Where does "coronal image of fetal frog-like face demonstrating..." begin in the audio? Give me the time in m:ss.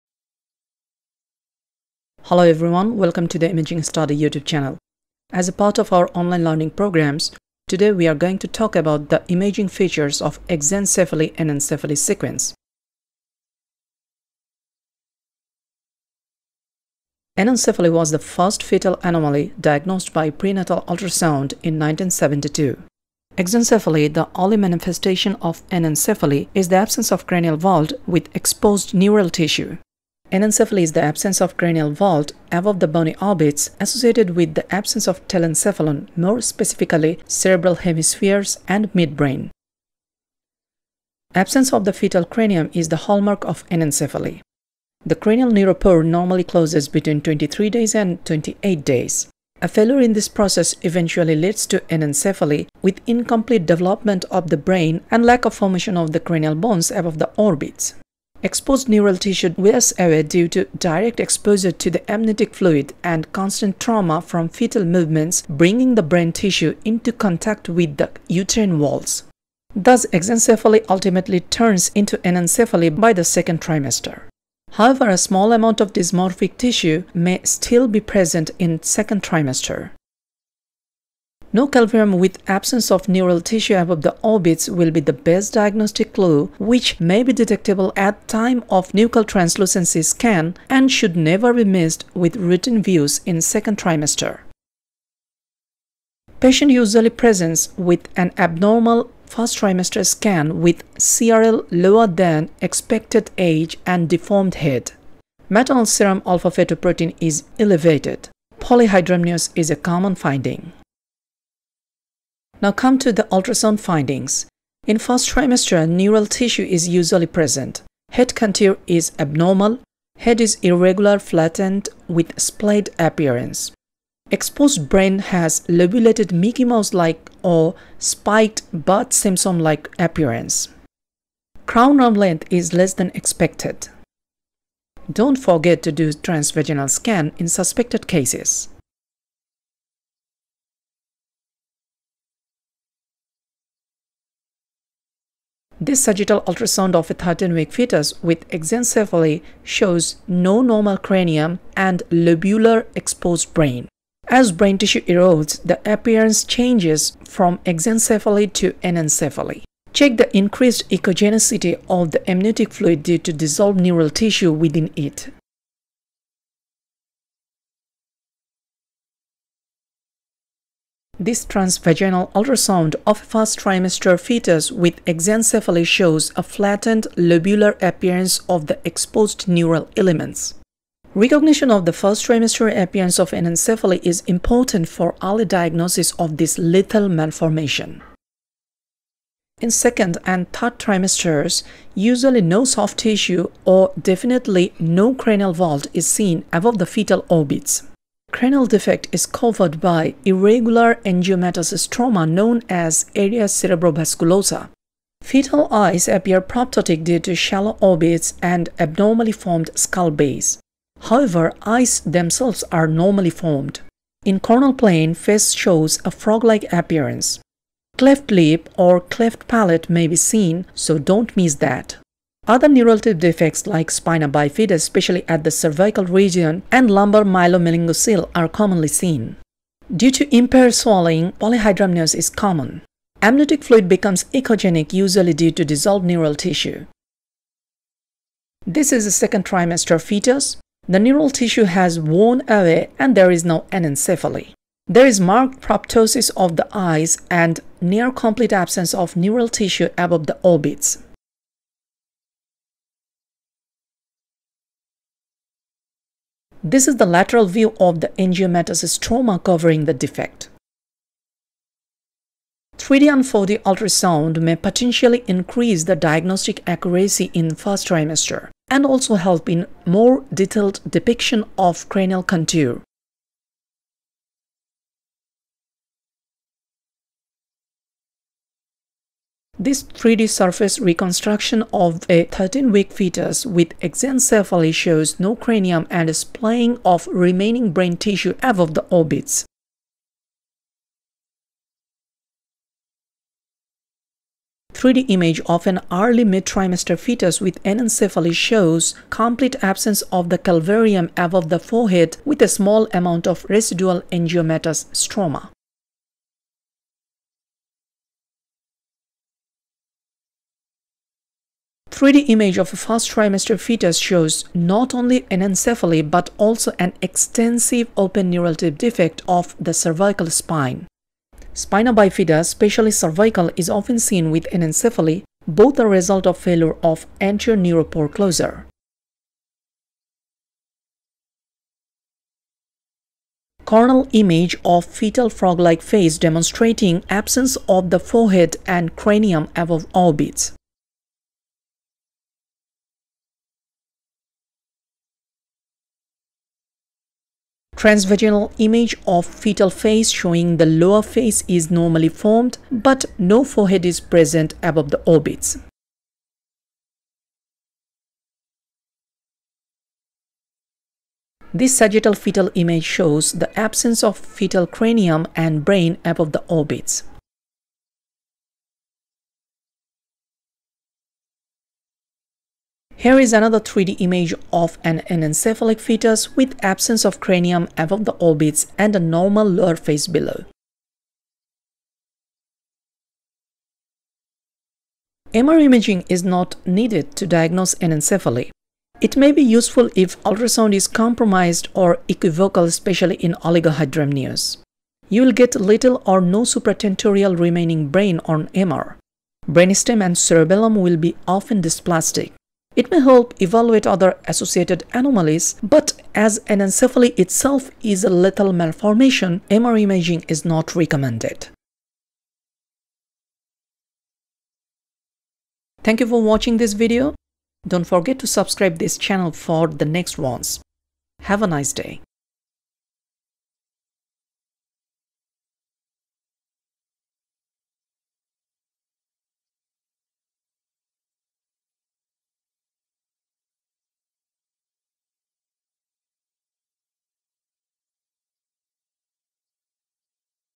5:33.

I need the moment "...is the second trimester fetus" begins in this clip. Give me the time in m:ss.
3:58.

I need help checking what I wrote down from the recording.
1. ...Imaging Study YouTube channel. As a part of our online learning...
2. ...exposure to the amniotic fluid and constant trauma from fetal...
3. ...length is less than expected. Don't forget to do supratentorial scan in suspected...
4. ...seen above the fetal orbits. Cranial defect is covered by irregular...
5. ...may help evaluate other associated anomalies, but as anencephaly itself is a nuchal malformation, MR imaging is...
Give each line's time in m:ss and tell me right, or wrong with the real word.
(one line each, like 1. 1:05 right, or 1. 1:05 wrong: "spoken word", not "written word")
1. 0:03 right
2. 1:01 right
3. 2:12 wrong: "transvaginal", not "supratentorial"
4. 3:16 right
5. 6:42 wrong: "lethal", not "nuchal".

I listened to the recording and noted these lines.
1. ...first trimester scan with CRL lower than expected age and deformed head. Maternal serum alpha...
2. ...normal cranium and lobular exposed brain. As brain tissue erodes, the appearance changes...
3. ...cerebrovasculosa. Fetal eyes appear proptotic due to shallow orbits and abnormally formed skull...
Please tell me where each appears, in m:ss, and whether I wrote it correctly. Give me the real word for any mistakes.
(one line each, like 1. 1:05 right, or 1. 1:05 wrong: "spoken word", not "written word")
1. 1:39 right
2. 2:30 right
3. 3:23 right.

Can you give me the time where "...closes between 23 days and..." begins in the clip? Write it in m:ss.
0:46.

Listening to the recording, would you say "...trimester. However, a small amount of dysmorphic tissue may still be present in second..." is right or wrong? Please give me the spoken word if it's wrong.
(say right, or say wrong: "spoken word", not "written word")
right.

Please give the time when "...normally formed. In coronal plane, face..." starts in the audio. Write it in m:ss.
3:32.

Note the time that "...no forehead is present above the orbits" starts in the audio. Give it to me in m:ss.
5:53.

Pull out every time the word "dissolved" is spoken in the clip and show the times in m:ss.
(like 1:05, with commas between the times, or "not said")
2:43, 3:55.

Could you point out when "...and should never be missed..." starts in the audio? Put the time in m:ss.
1:30.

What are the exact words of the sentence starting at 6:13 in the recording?
Here is another 3D image of an anencephalic fetus with absence of cranium above the orbits and a normal lower face below.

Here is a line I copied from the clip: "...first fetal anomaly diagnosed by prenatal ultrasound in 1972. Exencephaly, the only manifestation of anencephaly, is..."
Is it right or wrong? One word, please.
right.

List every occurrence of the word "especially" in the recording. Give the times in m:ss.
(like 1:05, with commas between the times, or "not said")
3:44, 5:22, 6:32.